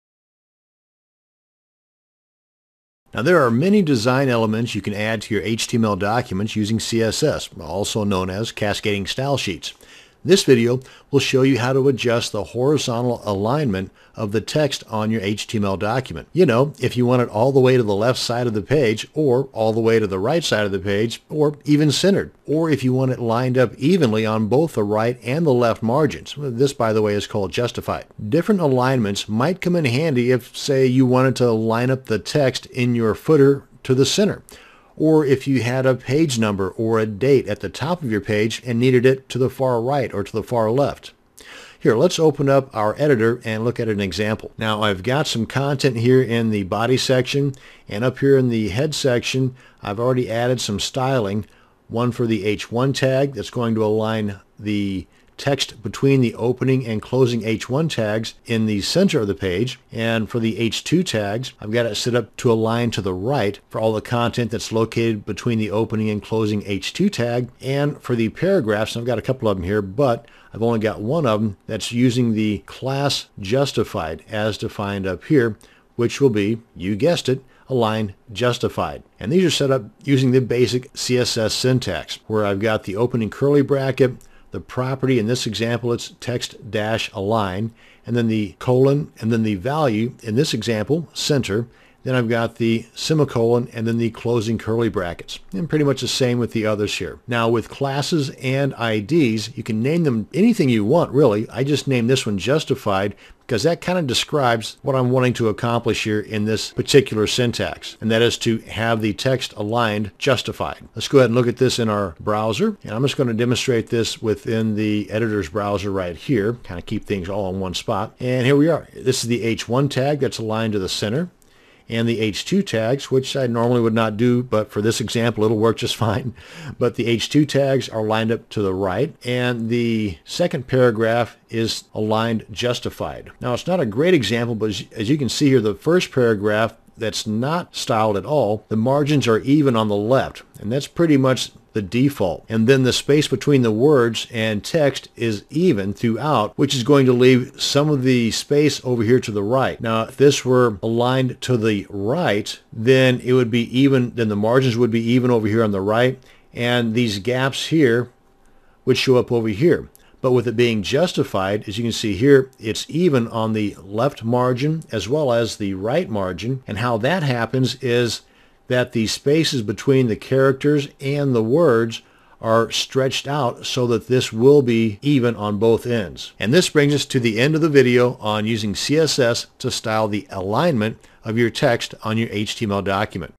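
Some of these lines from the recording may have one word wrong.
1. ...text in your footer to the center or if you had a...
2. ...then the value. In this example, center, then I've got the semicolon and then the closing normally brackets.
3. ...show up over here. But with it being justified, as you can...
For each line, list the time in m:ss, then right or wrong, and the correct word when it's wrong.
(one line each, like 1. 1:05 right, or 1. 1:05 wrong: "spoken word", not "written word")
1. 0:32 right
2. 1:29 wrong: "curly", not "normally"
3. 2:38 right.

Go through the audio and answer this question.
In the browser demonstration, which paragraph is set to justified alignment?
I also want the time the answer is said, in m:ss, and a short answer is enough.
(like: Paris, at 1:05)
the second paragraph, at 2:09.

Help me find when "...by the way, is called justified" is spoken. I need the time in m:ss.
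0:26.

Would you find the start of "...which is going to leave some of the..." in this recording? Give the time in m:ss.
2:26.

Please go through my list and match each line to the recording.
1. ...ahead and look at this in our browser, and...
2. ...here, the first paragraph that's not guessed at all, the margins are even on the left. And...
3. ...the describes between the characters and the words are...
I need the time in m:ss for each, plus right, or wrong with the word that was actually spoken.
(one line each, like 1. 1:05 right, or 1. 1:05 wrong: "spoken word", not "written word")
1. 1:51 right
2. 2:15 wrong: "styled", not "guessed"
3. 2:48 wrong: "spaces", not "describes".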